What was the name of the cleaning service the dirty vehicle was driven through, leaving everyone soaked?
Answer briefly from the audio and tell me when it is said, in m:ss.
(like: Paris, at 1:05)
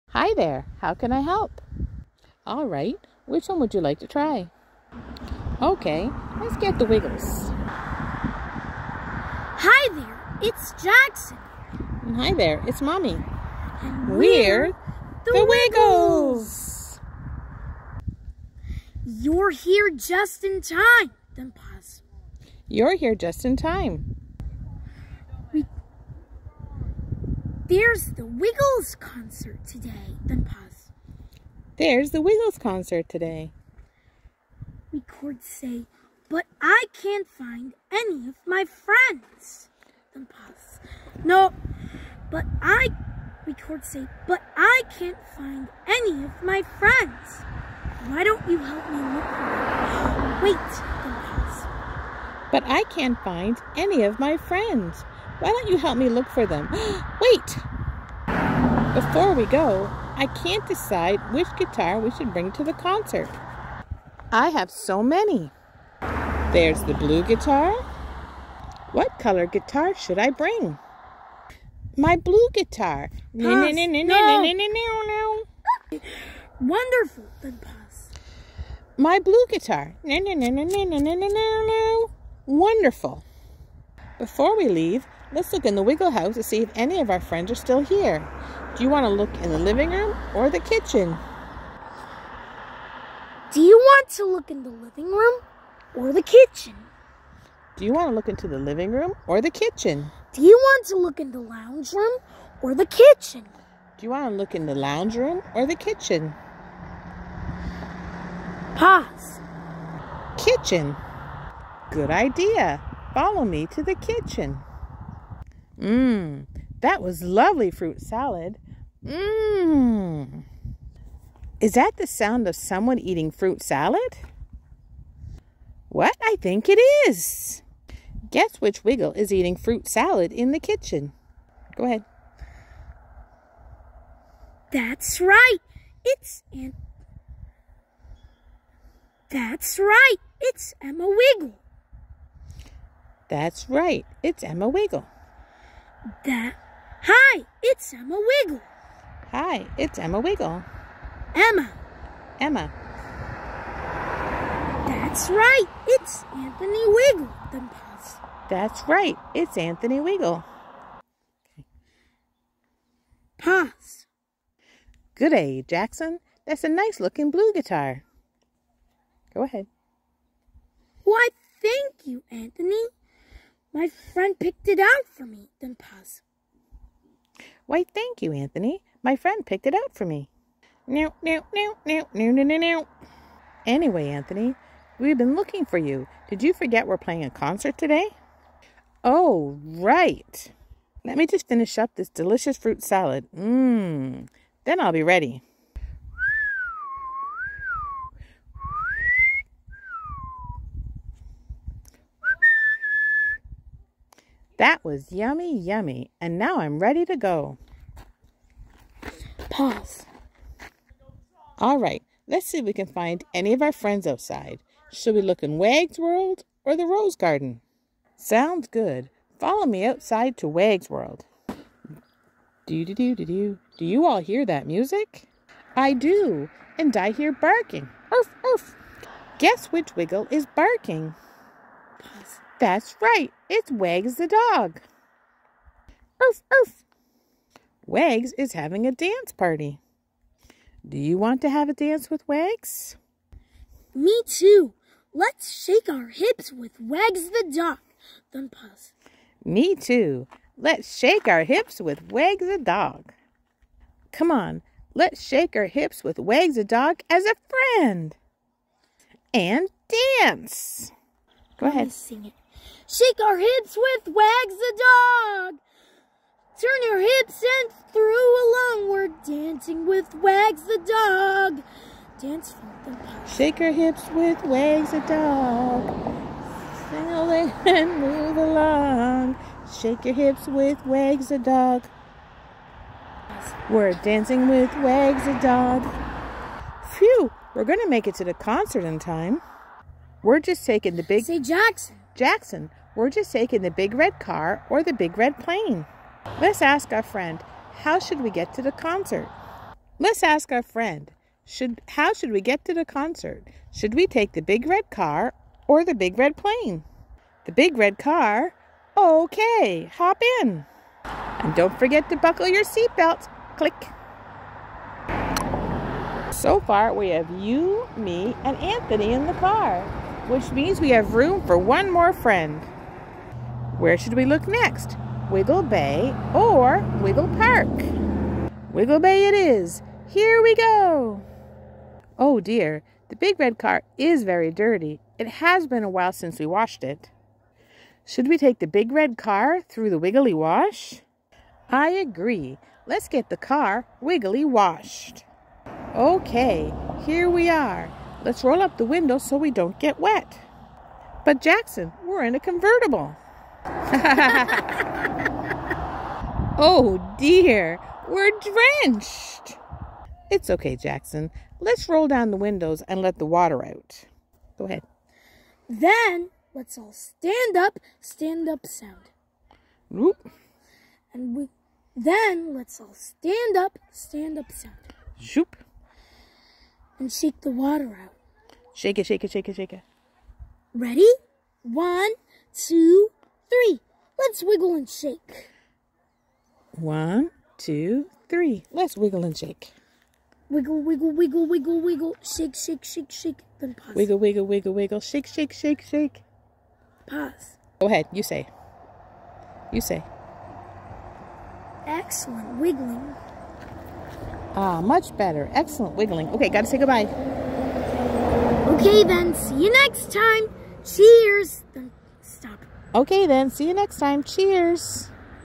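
Wiggly wash, at 5:39.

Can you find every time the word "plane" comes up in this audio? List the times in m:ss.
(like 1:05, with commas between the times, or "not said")
4:55, 5:06.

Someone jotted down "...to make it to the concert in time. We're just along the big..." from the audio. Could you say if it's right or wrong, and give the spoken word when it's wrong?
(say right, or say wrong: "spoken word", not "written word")
wrong: "taking", not "along".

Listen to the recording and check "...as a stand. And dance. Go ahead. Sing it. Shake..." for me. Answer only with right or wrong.
wrong.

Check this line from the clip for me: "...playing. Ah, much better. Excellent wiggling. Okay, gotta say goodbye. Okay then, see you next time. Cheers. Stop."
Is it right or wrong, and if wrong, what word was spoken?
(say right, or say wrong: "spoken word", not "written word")
wrong: "wiggling", not "playing".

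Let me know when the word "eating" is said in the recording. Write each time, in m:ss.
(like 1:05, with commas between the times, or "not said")
2:02, 2:09.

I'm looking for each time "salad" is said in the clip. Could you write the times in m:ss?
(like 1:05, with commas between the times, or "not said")
1:58, 2:03, 2:09, 3:12.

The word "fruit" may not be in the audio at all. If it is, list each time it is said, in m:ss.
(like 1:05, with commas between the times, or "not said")
1:57, 2:03, 2:09, 3:12.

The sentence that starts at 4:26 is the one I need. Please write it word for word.
Turn your hips and through along.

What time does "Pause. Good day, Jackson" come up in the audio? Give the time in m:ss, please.
2:43.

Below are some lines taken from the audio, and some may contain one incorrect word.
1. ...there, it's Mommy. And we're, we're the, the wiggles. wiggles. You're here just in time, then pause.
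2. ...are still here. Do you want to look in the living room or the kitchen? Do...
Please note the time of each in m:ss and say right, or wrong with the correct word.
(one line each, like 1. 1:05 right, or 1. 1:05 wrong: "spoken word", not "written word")
1. 0:12 right
2. 1:27 right.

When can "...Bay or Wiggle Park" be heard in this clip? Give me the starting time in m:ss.
5:25.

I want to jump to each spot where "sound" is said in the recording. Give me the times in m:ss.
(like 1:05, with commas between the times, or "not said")
2:02, 3:38, 6:08, 6:14.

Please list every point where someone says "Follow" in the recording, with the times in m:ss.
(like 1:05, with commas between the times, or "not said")
1:53, 3:39.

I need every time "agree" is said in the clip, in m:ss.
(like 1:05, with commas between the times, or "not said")
5:41.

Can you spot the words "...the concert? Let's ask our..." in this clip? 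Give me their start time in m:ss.
4:58.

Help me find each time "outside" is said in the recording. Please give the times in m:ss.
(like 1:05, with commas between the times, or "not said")
3:34, 3:39.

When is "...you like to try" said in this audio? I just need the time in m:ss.
0:03.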